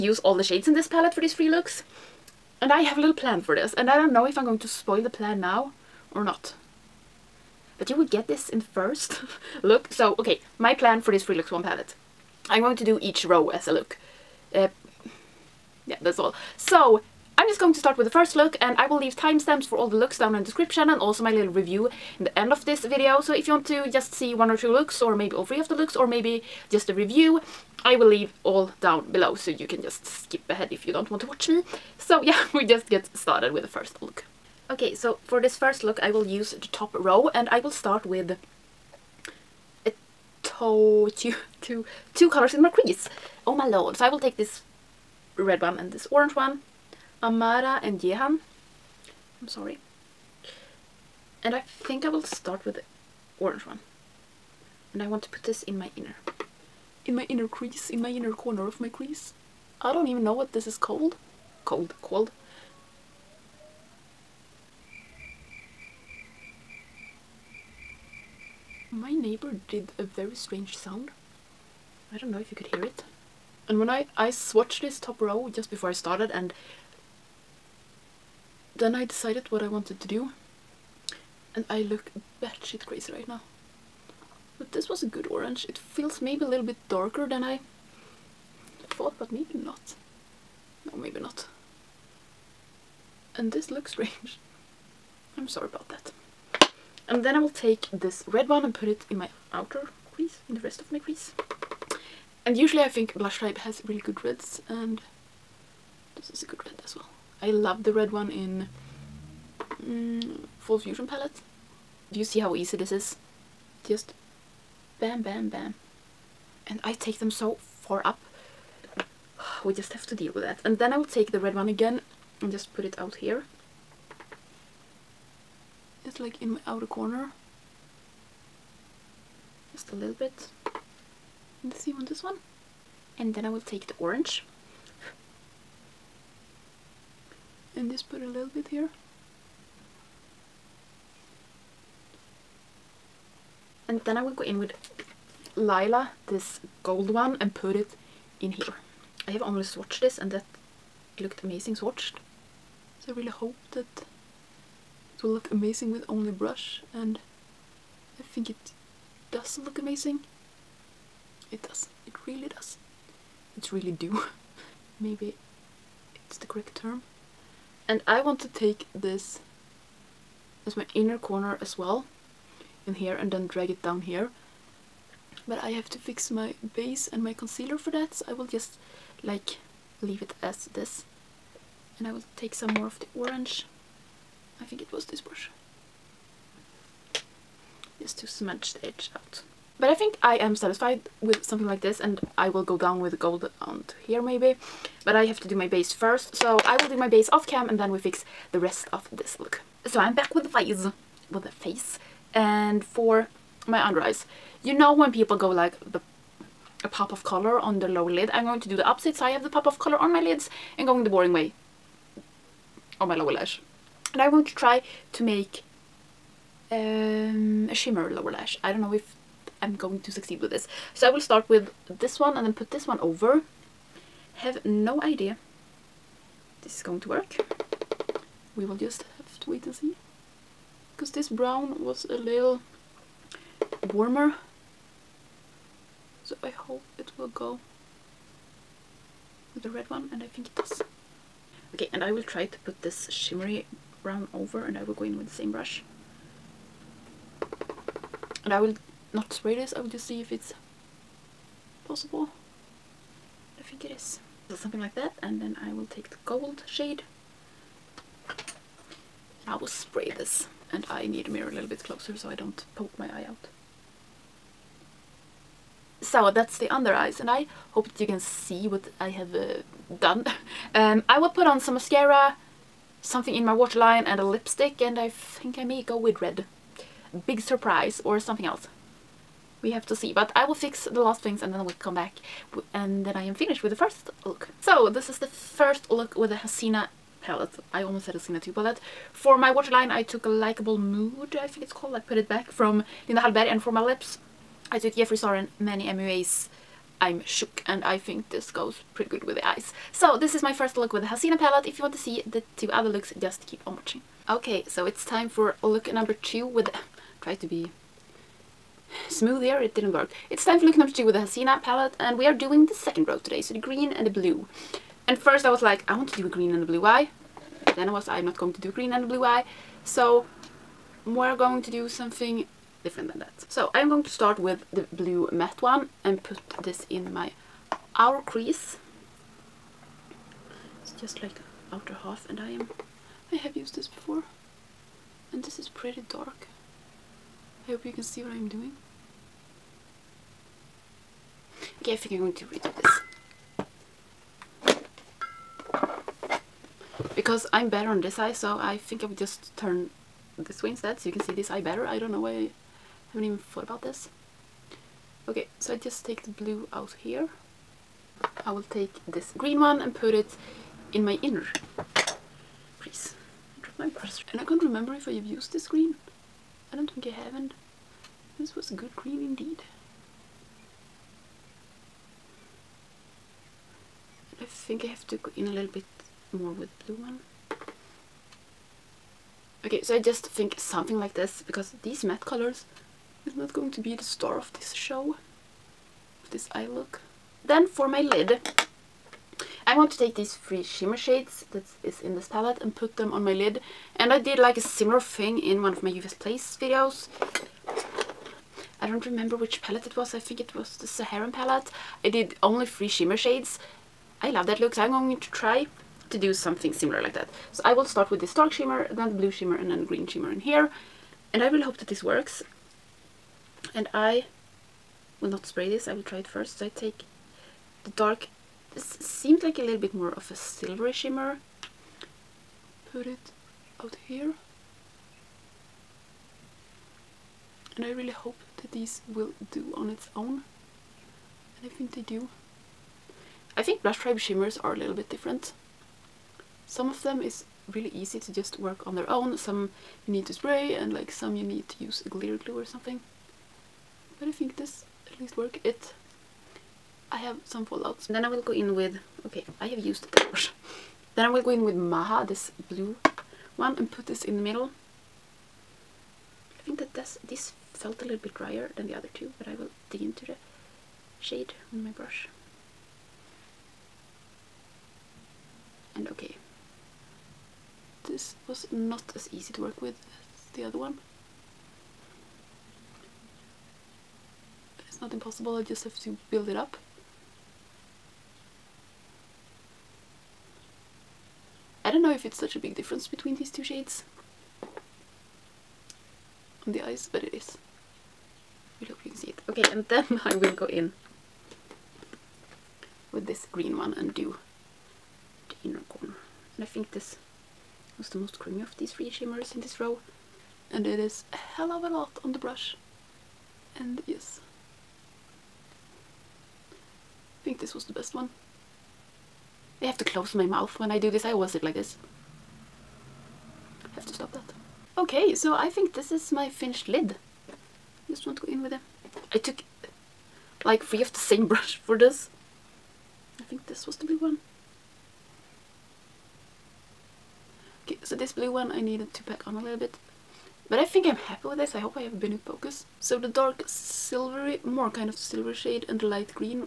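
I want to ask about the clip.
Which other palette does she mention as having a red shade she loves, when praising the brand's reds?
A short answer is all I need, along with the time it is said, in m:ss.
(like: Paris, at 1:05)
Full Fusion, at 1:50.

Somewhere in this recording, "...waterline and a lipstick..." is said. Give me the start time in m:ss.
4:33.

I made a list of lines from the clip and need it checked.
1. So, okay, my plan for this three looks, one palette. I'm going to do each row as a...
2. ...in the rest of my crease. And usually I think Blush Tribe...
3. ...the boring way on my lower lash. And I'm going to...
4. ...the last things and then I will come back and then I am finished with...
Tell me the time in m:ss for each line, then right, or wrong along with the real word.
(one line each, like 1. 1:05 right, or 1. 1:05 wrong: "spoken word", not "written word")
1. 0:09 right
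2. 1:40 right
3. 3:31 right
4. 4:40 right.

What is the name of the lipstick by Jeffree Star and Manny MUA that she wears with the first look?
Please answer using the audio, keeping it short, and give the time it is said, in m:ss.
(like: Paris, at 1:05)
I'm Shook, at 4:56.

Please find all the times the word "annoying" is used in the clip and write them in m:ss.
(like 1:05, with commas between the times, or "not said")
not said.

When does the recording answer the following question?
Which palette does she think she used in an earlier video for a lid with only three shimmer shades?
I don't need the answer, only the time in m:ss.
6:40.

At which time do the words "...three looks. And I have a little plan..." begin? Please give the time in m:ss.
0:01.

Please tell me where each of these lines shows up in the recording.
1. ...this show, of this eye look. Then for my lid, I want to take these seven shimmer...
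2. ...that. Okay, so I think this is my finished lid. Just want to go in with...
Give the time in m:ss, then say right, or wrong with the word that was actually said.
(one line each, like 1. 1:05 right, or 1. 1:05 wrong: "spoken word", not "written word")
1. 6:24 wrong: "three", not "seven"
2. 8:34 right.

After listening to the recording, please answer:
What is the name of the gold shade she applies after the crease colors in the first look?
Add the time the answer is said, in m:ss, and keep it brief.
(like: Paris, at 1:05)
Lila, at 2:25.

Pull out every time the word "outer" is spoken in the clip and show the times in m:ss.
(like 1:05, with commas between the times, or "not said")
1:39, 2:06, 5:31.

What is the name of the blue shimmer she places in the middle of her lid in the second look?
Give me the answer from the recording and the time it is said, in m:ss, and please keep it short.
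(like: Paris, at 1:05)
Maha, at 7:31.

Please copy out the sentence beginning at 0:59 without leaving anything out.
I don't even know what this is called.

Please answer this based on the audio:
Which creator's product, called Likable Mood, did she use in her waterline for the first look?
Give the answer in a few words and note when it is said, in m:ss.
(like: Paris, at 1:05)
Linda Hallberg, at 4:53.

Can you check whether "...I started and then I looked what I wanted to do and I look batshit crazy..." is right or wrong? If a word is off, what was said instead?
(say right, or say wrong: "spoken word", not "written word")
wrong: "decided", not "looked".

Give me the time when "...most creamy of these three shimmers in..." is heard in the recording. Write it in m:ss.
8:18.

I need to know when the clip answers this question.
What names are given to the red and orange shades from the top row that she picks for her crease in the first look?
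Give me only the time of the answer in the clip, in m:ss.
0:47.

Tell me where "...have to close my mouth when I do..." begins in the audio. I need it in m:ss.
8:29.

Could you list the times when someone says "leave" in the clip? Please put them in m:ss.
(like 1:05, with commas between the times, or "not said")
0:18, 0:28, 3:00.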